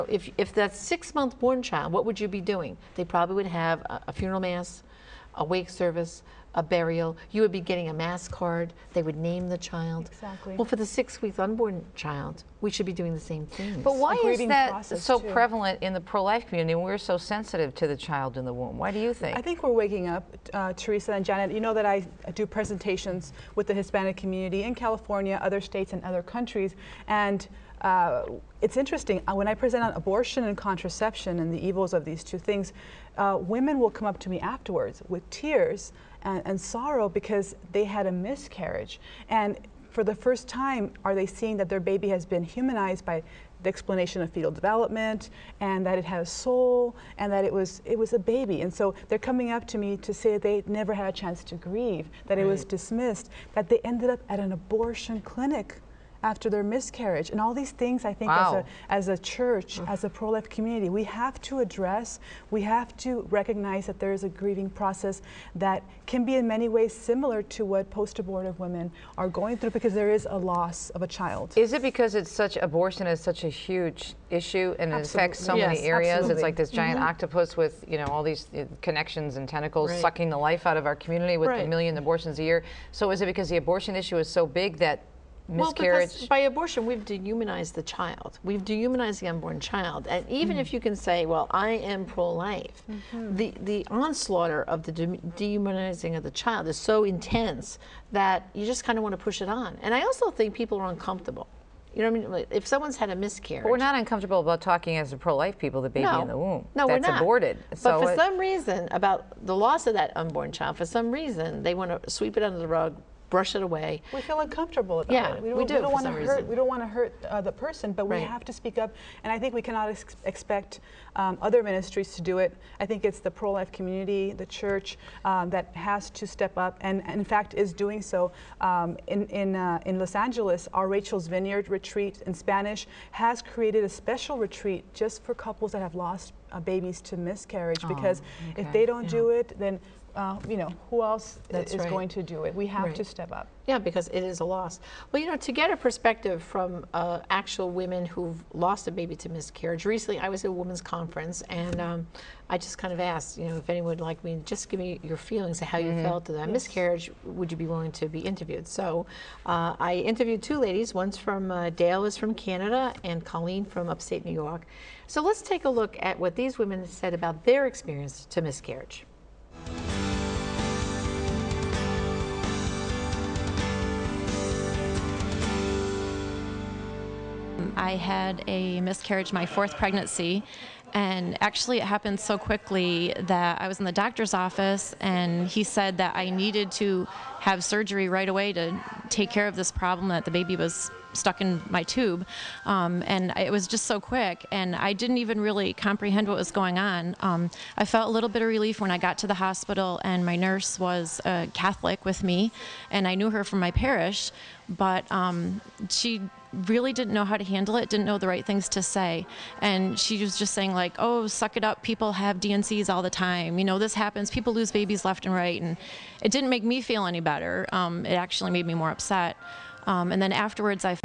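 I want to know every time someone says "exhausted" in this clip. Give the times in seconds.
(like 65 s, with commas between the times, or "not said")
not said.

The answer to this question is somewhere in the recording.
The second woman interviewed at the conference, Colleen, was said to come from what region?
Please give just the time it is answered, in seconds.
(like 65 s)
163 s.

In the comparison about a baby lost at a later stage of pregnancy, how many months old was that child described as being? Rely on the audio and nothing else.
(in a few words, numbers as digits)
6.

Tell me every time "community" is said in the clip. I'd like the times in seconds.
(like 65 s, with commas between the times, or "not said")
16 s, 24 s, 60 s, 80 s, 123 s.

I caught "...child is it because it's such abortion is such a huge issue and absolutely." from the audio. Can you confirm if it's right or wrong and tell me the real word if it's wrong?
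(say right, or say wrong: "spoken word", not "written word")
right.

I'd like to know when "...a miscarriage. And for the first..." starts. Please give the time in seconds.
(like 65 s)
38 s.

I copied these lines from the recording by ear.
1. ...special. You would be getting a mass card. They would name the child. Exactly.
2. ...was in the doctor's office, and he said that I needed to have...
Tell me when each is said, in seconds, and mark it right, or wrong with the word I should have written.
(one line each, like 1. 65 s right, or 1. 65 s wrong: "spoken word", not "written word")
1. 6 s wrong: "burial", not "special"
2. 183 s right.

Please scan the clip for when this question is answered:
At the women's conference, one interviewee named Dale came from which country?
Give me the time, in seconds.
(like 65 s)
162 s.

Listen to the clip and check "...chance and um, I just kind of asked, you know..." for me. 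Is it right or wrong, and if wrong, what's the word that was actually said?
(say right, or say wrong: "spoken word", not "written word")
wrong: "conference", not "chance".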